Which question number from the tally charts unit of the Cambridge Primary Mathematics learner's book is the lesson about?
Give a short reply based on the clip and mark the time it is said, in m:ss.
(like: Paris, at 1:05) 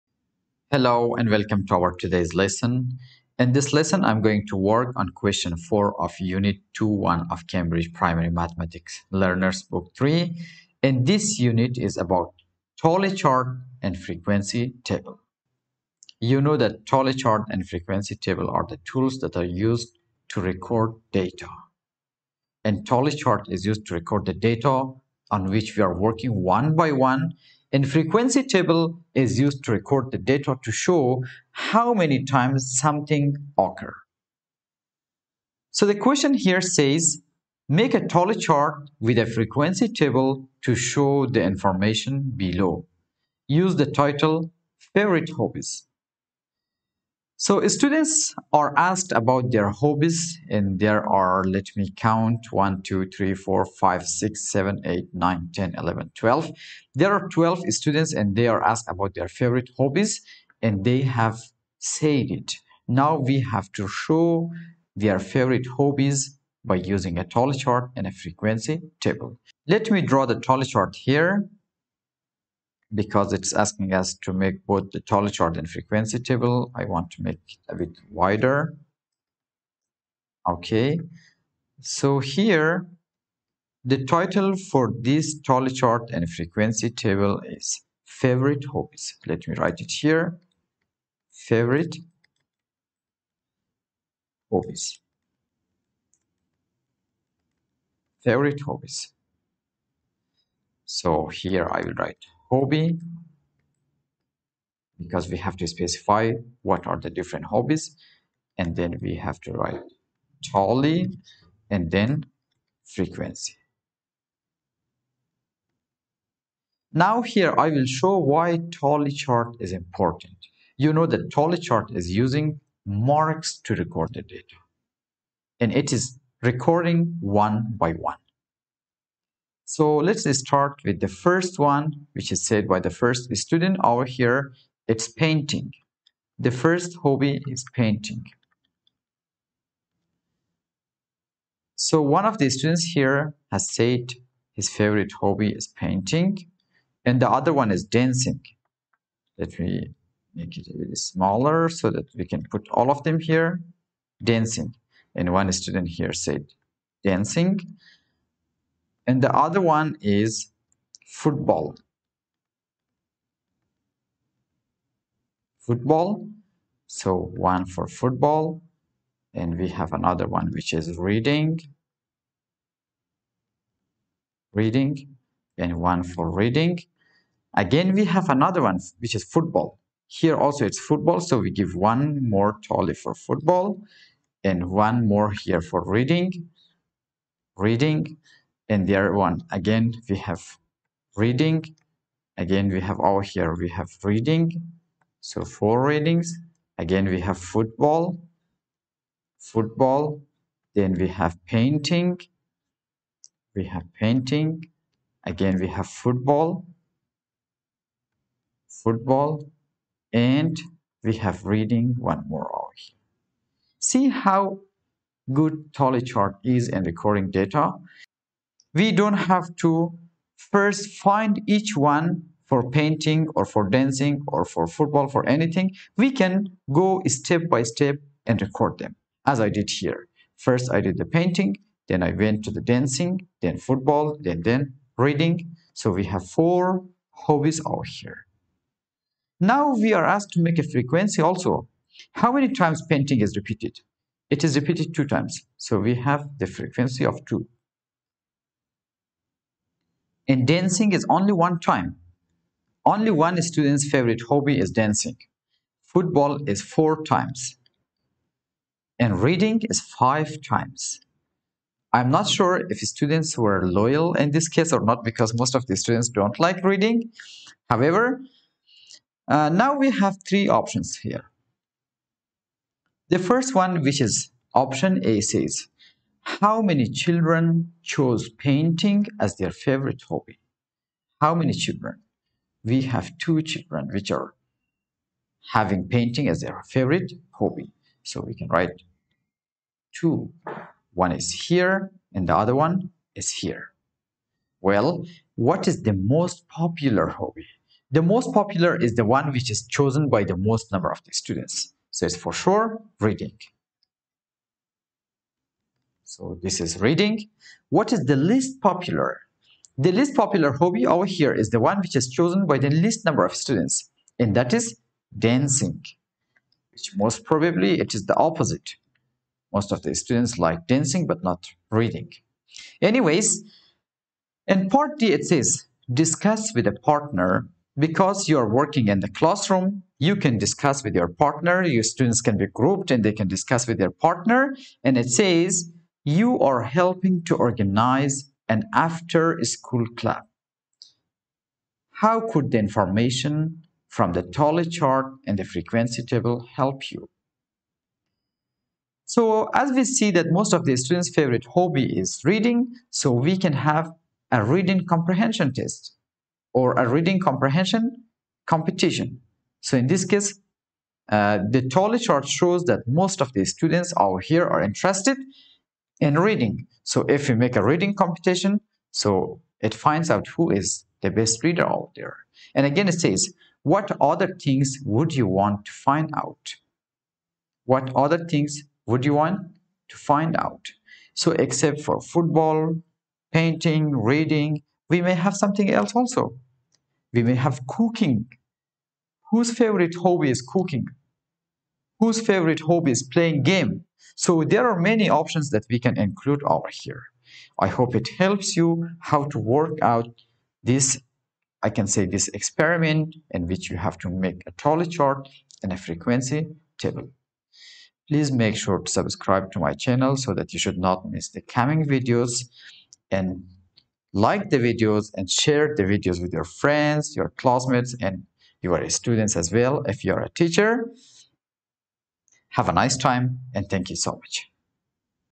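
4, at 0:05.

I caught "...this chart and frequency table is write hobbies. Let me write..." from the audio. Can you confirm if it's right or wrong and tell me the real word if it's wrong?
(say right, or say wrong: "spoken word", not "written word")
wrong: "favorite", not "write".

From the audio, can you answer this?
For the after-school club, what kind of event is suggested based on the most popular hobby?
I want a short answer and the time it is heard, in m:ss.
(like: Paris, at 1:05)
Reading competition, at 5:56.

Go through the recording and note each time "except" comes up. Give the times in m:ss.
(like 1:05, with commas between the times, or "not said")
6:21.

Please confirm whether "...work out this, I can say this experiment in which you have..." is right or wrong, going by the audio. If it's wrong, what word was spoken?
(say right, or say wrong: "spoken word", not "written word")
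right.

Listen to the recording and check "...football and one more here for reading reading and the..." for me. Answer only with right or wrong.
right.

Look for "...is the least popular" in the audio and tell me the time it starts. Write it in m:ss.
5:07.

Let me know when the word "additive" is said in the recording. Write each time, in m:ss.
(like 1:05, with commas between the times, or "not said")
not said.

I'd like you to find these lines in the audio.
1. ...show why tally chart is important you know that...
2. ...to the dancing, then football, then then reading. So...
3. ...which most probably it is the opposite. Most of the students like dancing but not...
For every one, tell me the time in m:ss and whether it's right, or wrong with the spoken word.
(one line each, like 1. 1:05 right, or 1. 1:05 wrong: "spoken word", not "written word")
1. 1:57 right
2. 3:52 right
3. 5:16 right.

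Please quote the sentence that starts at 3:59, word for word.
Now we are asked to make a frequency also.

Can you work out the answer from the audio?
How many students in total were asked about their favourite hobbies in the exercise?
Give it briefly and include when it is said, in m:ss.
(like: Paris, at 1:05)
12, at 0:56.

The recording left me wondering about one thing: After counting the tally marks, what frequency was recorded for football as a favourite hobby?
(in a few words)
4.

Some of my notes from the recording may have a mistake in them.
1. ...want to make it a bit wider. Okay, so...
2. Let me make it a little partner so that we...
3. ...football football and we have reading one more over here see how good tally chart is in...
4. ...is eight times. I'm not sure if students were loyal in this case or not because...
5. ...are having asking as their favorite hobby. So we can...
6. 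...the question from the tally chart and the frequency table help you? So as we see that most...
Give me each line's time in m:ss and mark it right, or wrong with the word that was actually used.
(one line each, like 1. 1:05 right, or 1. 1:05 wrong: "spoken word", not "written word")
1. 1:16 right
2. 2:29 wrong: "smaller", not "partner"
3. 3:25 right
4. 4:19 wrong: "five", not "eight"
5. 4:44 wrong: "painting", not "asking"
6. 5:42 wrong: "information", not "question".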